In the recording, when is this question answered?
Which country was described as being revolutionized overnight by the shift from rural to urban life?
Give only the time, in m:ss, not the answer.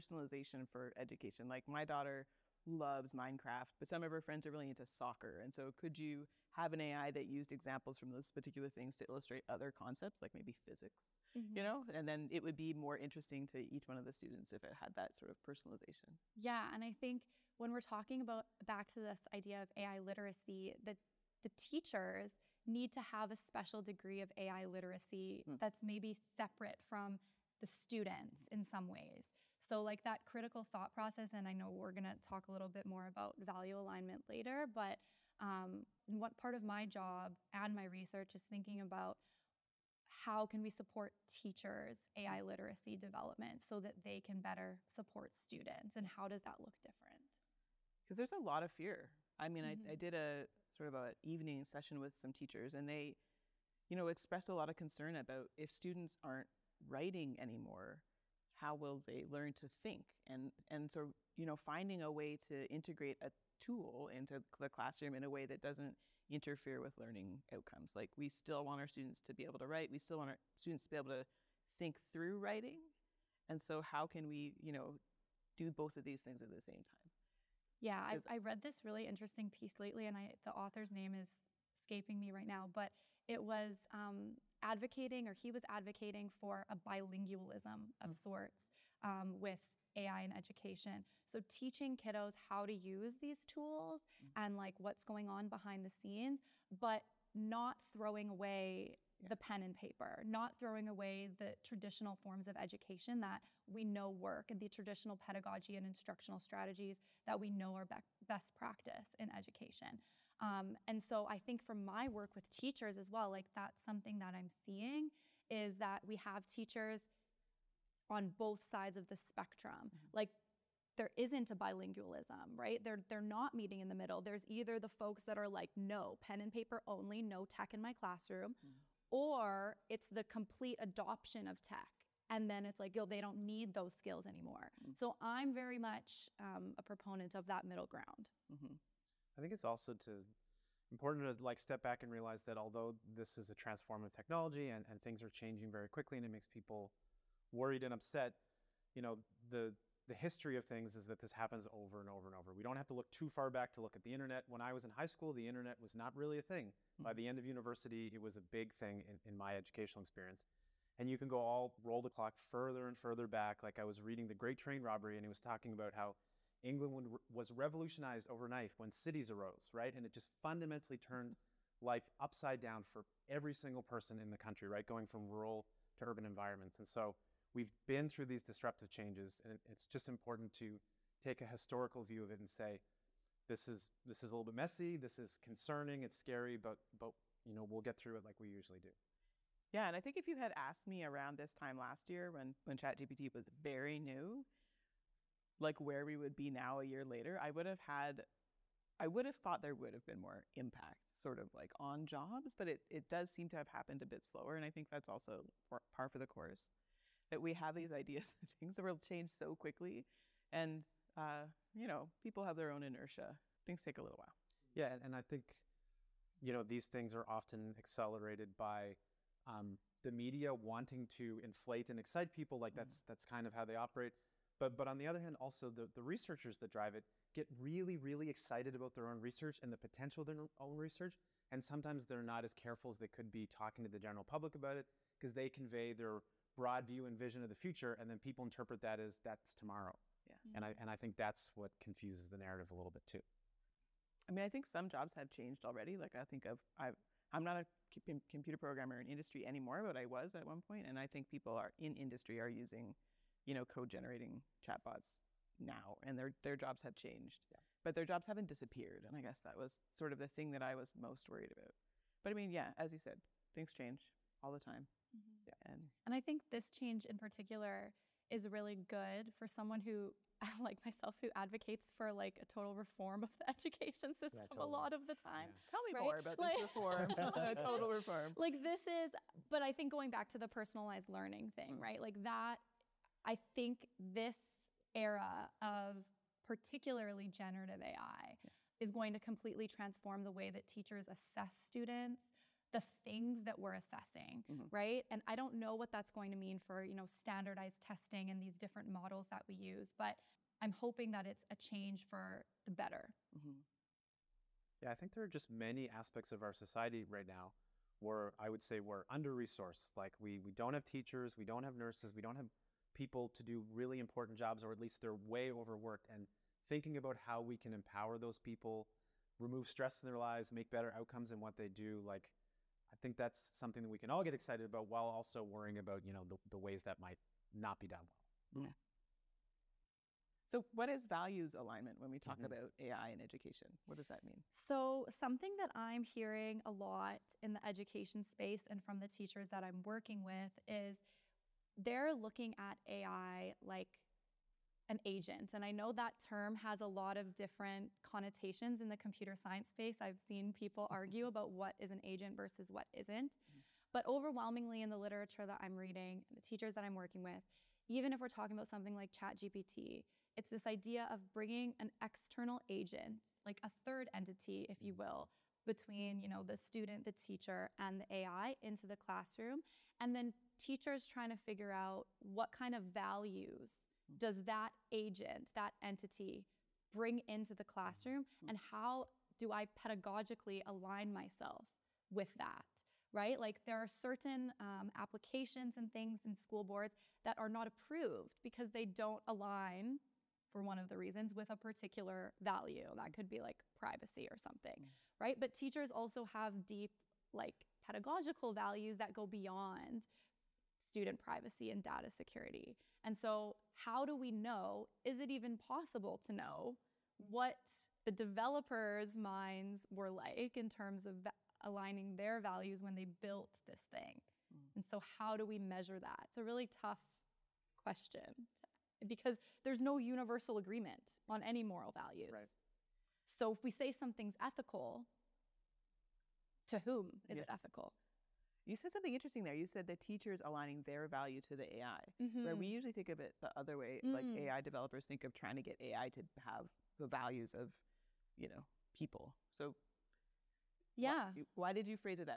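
2:46.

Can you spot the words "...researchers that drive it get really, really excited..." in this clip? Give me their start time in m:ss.
3:46.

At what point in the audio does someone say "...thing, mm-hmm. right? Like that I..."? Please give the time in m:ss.
4:41.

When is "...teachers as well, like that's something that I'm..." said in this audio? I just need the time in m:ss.
1:52.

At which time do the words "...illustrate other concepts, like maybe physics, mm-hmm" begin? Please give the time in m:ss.
0:09.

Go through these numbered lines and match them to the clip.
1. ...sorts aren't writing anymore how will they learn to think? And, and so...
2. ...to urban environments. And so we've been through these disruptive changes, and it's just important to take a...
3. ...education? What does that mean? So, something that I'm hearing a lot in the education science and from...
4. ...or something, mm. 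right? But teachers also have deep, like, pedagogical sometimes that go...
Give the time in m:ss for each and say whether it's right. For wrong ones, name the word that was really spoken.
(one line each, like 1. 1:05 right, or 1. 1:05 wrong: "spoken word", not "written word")
1. 0:55 wrong: "students", not "sorts"
2. 2:55 right
3. 5:33 wrong: "space", not "science"
4. 6:34 wrong: "values", not "sometimes".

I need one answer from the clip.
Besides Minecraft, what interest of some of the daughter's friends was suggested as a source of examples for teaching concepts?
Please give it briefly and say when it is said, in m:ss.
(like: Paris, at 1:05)
Soccer, at 0:04.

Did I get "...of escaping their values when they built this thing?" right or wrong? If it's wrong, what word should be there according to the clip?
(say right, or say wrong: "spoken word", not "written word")
wrong: "aligning", not "escaping".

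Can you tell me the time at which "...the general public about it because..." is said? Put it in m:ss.
3:53.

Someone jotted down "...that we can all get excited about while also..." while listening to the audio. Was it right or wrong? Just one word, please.
right.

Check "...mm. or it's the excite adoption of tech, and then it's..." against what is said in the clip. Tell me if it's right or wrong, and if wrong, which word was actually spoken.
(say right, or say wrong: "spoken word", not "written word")
wrong: "complete", not "excite".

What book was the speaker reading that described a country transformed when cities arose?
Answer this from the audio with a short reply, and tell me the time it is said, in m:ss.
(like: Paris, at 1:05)
The Great Train Robbery, at 2:44.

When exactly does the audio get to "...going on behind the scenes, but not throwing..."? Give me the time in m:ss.
1:35.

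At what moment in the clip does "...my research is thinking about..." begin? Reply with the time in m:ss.
0:37.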